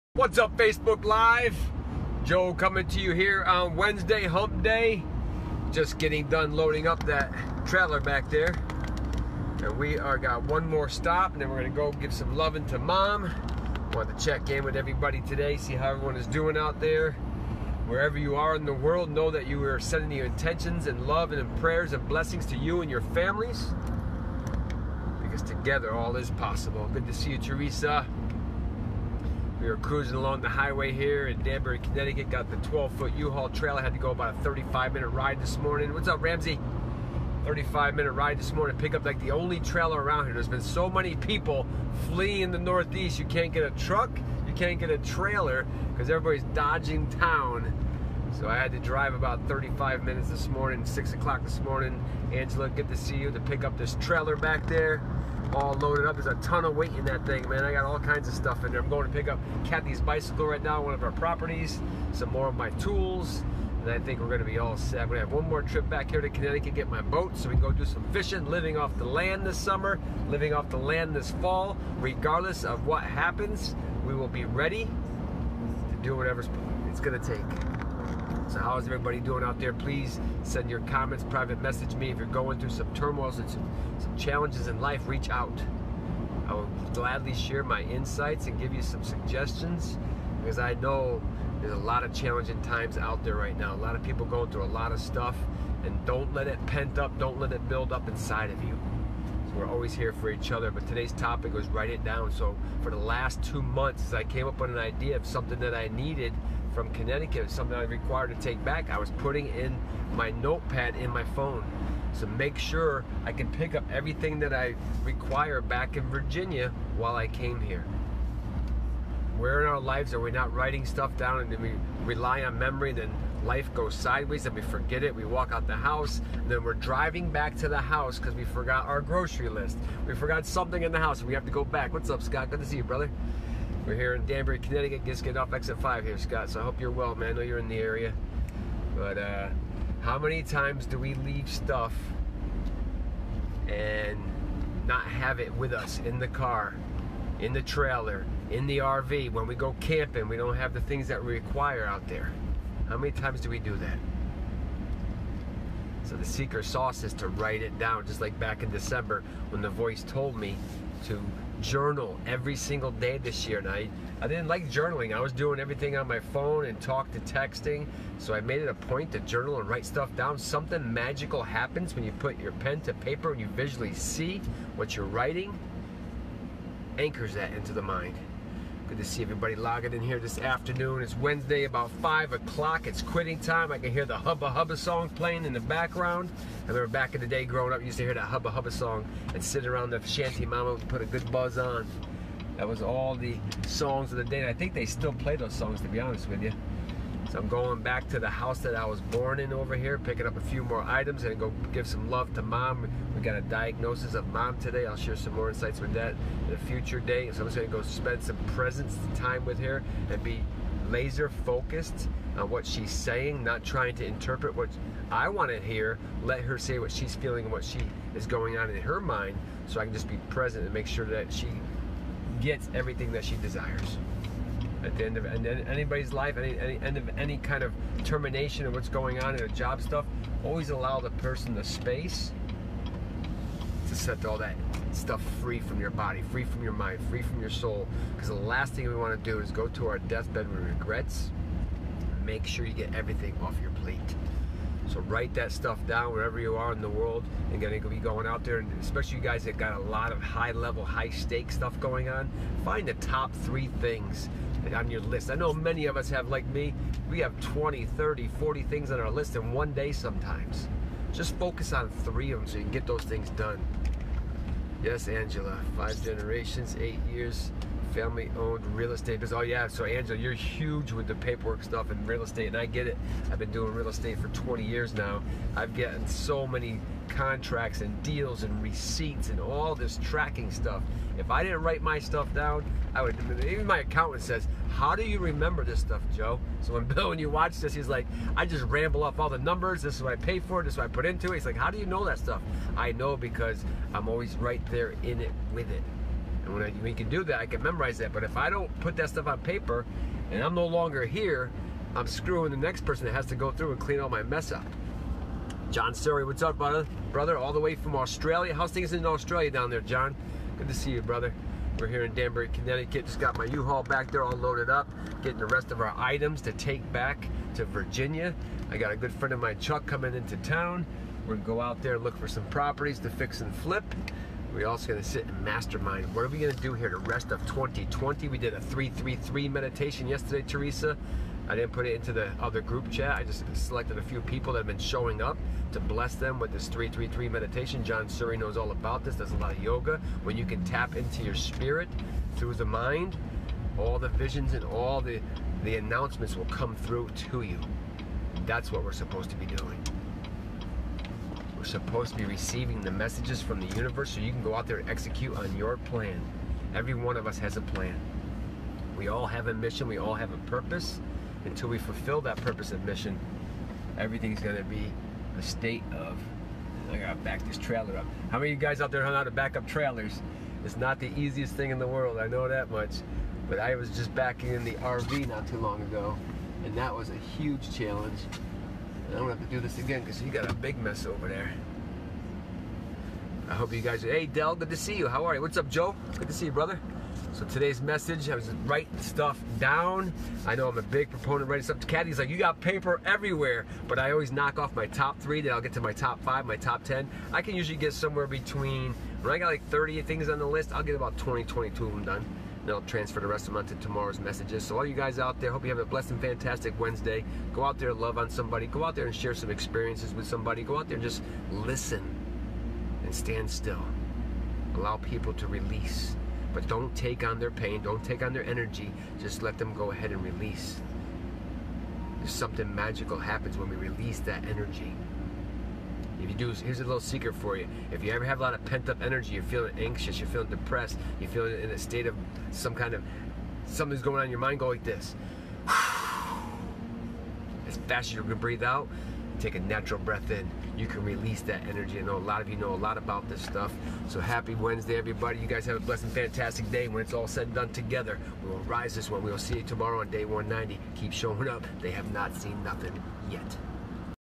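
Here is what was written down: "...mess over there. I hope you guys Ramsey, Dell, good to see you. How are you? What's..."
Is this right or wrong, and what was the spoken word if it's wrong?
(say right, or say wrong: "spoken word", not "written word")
wrong: "Hey", not "Ramsey".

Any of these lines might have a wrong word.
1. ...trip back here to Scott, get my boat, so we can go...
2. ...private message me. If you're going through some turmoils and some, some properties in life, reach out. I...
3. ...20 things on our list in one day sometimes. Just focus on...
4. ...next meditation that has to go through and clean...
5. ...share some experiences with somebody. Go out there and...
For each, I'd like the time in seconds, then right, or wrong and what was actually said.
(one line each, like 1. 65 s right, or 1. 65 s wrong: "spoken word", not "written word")
1. 65 s wrong: "Connecticut", not "Scott"
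2. 81 s wrong: "challenges", not "properties"
3. 258 s wrong: "40", not "20"
4. 302 s wrong: "person", not "meditation"
5. 409 s right.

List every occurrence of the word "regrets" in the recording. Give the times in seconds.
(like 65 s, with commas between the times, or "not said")
240 s.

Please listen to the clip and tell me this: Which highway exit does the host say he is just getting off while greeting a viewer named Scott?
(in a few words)
Exit 5.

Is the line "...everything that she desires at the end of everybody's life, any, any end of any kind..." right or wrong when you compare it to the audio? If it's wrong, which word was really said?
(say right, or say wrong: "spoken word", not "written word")
wrong: "anybody", not "everybody".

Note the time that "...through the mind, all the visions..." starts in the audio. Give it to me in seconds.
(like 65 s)
342 s.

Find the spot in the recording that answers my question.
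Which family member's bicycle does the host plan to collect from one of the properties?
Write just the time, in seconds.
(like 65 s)
59 s.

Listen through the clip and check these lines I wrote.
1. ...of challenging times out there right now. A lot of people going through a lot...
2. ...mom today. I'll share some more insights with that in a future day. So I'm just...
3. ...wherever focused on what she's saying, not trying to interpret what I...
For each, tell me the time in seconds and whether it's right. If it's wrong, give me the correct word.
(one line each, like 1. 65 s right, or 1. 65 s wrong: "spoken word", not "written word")
1. 92 s right
2. 204 s right
3. 210 s wrong: "laser", not "wherever".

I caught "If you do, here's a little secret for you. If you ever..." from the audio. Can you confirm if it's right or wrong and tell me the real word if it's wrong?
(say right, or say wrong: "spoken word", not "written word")
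right.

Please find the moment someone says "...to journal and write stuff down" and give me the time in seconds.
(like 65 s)
169 s.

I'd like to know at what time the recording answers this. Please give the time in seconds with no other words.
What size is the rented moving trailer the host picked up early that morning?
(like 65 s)
32 s.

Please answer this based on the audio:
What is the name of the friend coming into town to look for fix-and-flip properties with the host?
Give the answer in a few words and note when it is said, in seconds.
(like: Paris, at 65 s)
Chuck, at 319 s.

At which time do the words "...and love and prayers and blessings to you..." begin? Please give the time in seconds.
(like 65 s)
20 s.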